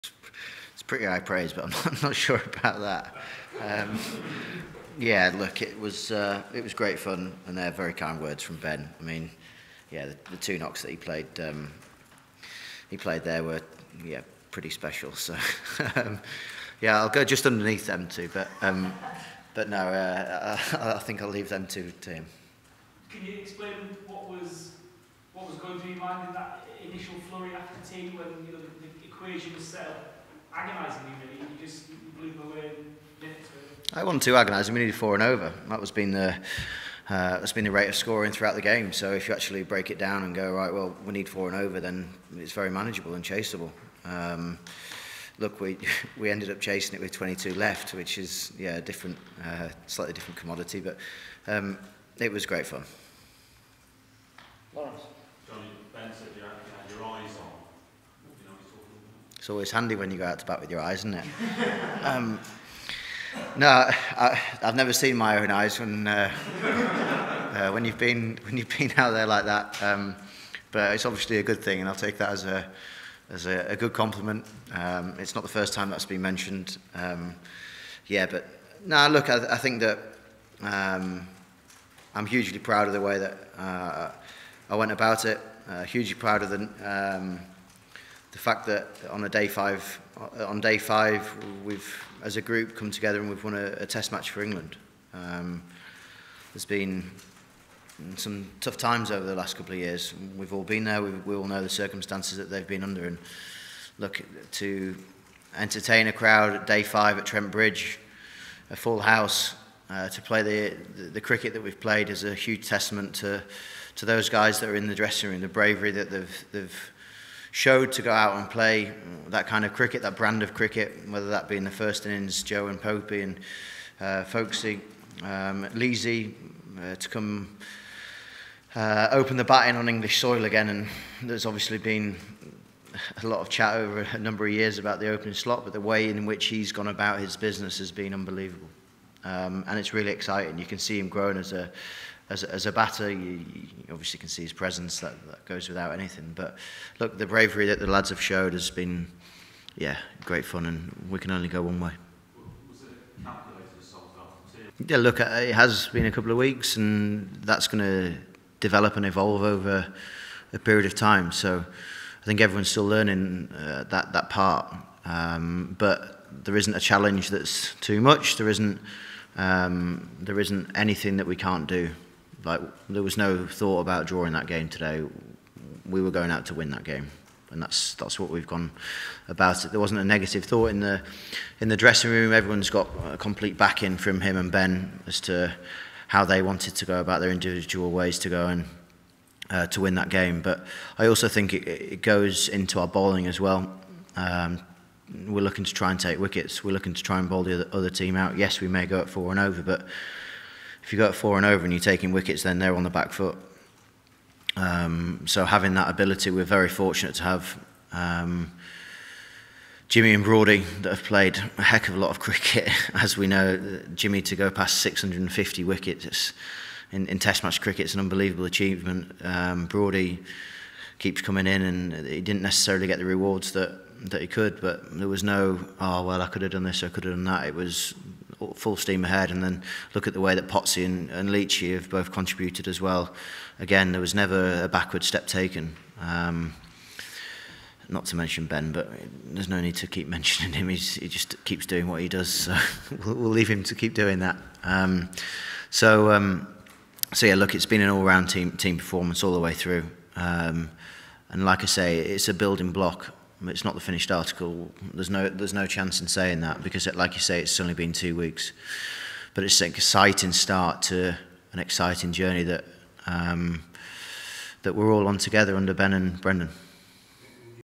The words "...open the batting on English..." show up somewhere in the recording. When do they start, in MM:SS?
02:09.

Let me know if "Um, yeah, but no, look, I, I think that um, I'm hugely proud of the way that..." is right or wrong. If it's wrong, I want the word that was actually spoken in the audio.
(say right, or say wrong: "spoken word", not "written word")
right.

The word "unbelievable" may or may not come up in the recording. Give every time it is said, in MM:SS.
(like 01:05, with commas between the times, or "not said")
02:18, 03:37.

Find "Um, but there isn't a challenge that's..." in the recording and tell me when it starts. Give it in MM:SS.
02:45.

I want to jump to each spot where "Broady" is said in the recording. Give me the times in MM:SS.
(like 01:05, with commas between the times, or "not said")
03:30, 03:39.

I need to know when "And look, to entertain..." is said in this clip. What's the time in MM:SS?
01:43.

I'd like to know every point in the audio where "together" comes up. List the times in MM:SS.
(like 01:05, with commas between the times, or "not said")
01:32, 04:25.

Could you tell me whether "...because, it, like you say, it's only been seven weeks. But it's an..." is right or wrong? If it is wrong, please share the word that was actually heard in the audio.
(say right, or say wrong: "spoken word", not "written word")
wrong: "two", not "seven".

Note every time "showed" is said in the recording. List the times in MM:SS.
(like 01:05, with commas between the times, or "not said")
01:57, 02:28.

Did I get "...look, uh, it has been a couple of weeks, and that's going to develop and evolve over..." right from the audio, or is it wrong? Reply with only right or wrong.
right.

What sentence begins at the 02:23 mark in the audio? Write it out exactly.
You, you obviously can see his presence.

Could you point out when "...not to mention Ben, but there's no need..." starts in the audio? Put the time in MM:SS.
03:57.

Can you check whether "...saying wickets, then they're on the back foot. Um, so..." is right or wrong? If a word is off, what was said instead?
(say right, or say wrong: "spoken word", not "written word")
wrong: "taking", not "saying".